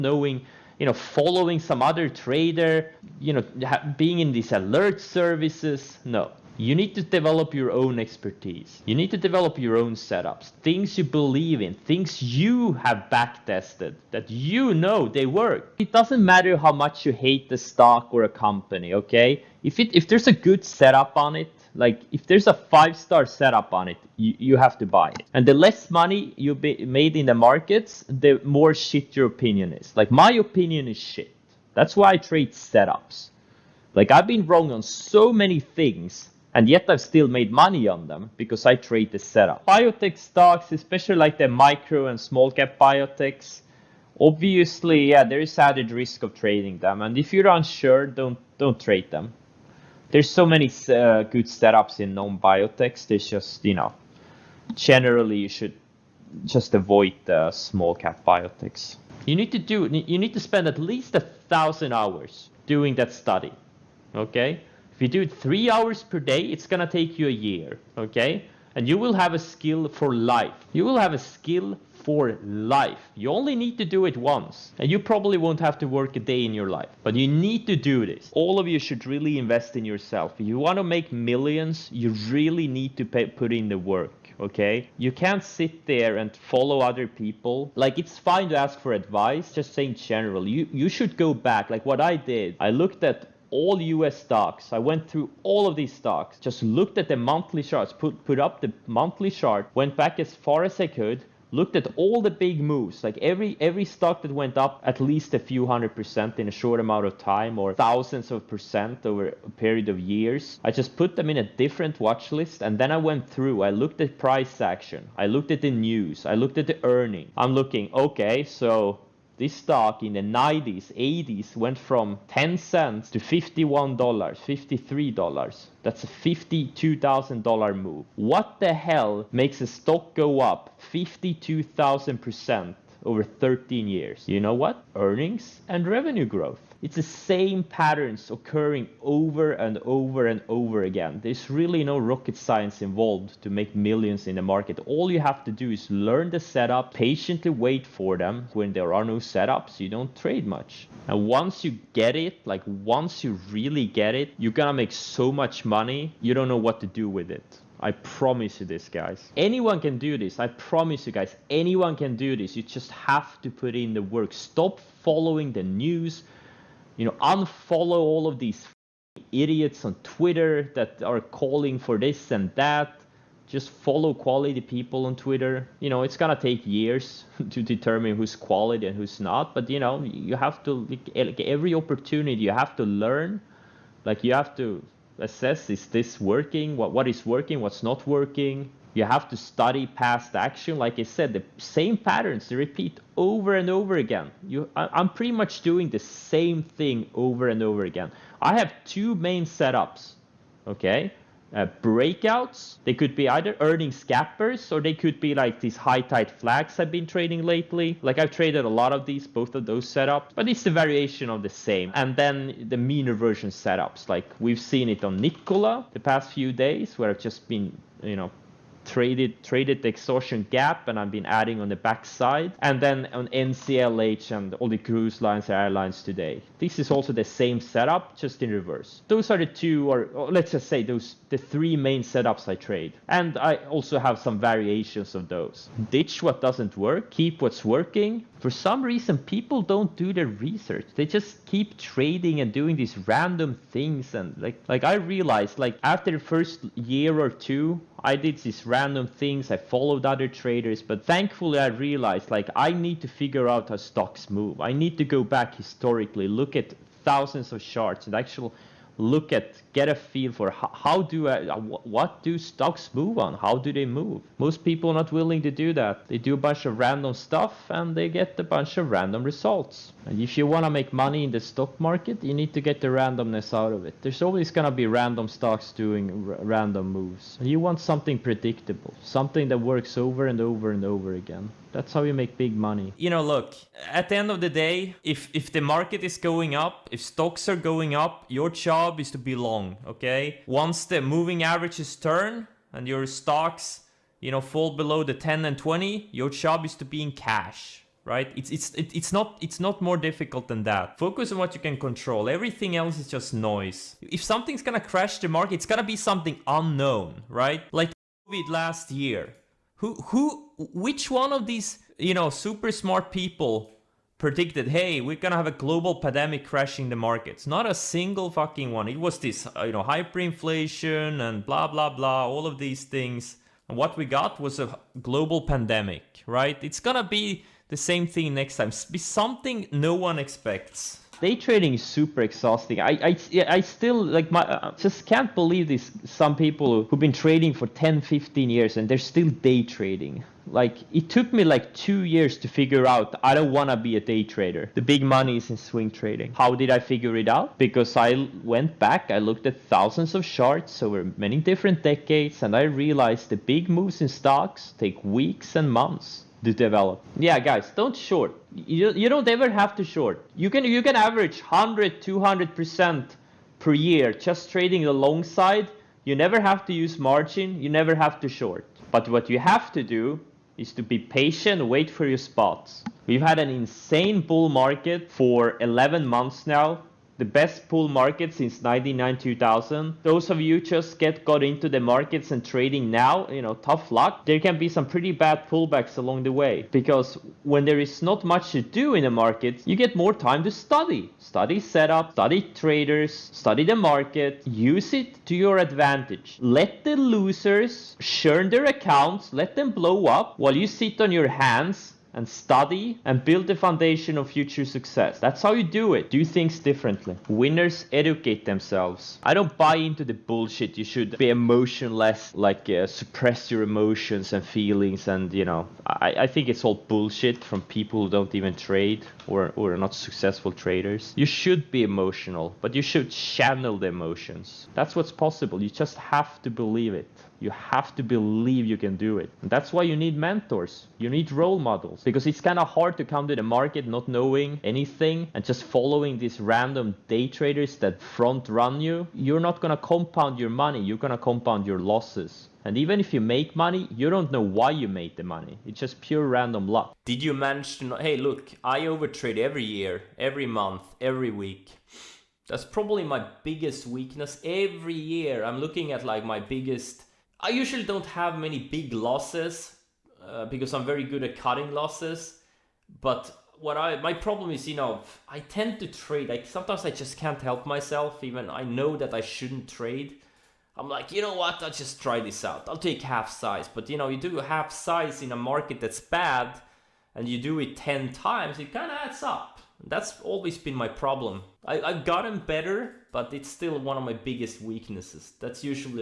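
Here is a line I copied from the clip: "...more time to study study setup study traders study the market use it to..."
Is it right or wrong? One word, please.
right.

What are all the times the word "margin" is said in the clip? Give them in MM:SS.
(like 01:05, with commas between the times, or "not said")
06:06.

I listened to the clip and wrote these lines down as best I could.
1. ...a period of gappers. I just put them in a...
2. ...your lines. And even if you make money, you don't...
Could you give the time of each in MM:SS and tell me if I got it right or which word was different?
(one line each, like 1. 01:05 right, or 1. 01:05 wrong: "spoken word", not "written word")
1. 01:49 wrong: "years", not "gappers"
2. 07:21 wrong: "losses", not "lines".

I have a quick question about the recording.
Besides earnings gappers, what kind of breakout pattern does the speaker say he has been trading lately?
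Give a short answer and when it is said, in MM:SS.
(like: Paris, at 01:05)
High tight flags, at 03:25.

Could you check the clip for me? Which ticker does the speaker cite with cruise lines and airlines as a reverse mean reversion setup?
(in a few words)
NCLH.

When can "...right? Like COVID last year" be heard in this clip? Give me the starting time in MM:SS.
05:07.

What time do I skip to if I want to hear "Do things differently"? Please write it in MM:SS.
06:46.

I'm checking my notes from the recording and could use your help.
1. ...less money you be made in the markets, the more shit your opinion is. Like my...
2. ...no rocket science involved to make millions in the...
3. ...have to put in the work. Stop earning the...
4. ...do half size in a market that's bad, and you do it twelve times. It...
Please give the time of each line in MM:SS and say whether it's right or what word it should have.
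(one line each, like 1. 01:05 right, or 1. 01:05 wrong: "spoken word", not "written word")
1. 00:25 right
2. 02:21 right
3. 02:42 wrong: "following", not "earning"
4. 07:54 wrong: "ten", not "twelve".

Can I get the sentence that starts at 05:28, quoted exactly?
Be something no one expects day trading is super exhausting.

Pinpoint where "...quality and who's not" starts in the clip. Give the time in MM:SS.
02:58.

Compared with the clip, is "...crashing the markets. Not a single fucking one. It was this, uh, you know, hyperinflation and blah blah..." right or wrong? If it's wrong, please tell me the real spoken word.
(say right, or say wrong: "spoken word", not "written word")
right.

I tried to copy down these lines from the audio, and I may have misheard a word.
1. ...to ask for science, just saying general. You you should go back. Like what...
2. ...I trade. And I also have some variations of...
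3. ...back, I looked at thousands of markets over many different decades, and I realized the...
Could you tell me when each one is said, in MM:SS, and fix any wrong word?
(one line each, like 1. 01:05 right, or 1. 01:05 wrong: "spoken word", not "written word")
1. 01:28 wrong: "advice", not "science"
2. 03:52 right
3. 05:48 wrong: "charts", not "markets".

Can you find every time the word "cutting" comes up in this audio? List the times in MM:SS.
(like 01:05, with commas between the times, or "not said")
07:41.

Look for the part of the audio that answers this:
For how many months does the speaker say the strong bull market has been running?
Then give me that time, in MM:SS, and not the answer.
06:15.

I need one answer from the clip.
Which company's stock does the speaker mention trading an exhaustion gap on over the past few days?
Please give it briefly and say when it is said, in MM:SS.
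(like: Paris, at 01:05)
Nikola, at 03:35.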